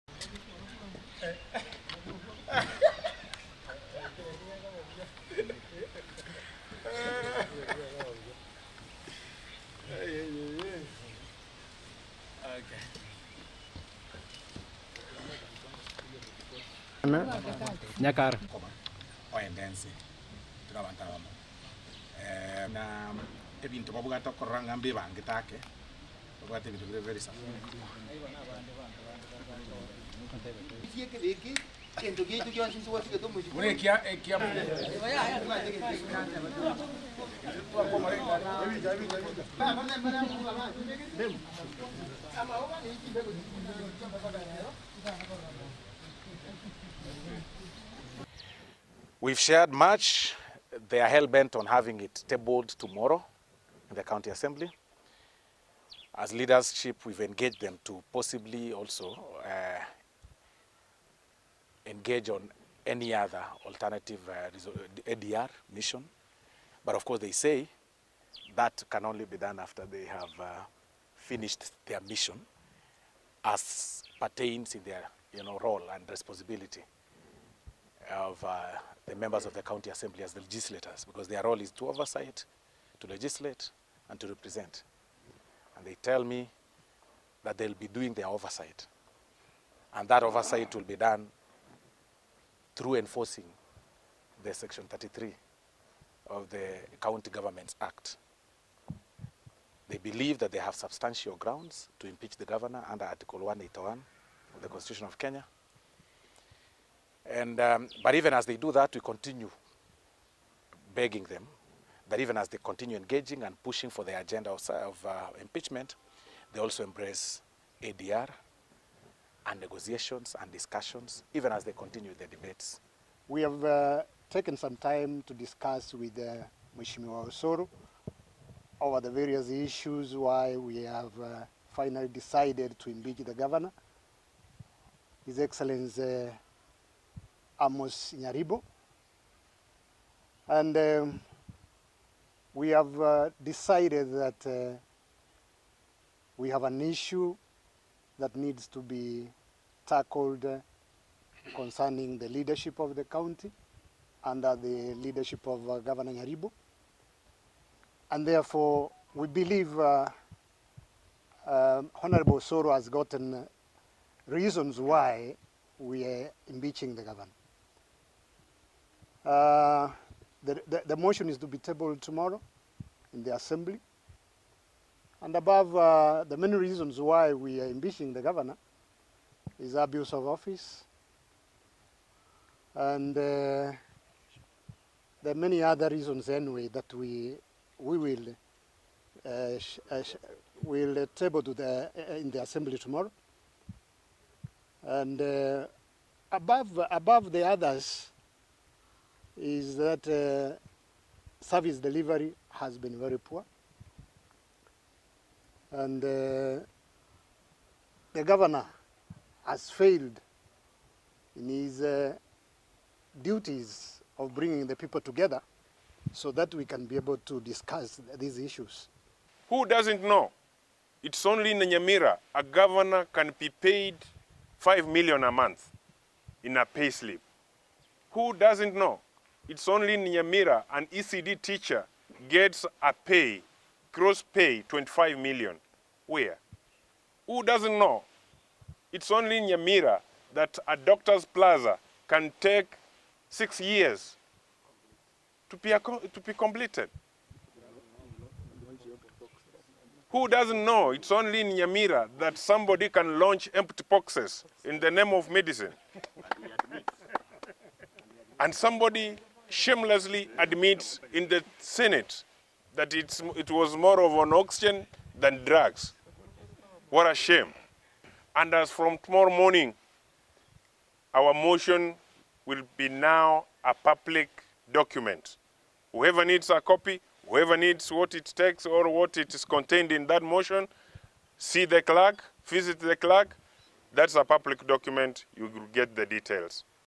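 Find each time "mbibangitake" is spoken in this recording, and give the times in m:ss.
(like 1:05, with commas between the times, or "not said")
0:24.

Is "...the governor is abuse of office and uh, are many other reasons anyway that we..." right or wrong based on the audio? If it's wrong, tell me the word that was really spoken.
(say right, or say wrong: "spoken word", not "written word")
right.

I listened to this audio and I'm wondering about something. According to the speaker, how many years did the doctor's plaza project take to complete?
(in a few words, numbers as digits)
6.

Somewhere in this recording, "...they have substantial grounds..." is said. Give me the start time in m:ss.
1:40.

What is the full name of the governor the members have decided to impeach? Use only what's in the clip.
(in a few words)
Amos Nyaribo.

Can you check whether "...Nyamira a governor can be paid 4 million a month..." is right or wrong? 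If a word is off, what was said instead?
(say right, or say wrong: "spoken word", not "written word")
wrong: "5", not "4".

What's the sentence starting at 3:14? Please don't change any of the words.
And uh, above, above the others, is that uh, service delivery has been very poor.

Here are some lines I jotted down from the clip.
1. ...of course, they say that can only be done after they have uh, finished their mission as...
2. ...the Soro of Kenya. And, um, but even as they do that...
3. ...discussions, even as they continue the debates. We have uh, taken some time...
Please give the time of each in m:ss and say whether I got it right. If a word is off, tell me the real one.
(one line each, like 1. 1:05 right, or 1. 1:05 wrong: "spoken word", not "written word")
1. 1:06 right
2. 1:44 wrong: "Constitution", not "Soro"
3. 2:00 right.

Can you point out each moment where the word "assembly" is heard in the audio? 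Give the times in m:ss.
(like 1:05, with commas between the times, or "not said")
0:54, 1:19, 2:53, 3:12.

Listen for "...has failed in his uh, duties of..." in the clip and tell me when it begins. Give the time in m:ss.
3:29.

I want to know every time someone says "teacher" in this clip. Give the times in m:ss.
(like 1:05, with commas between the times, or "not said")
3:51.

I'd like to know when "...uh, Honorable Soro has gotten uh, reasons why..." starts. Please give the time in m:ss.
2:41.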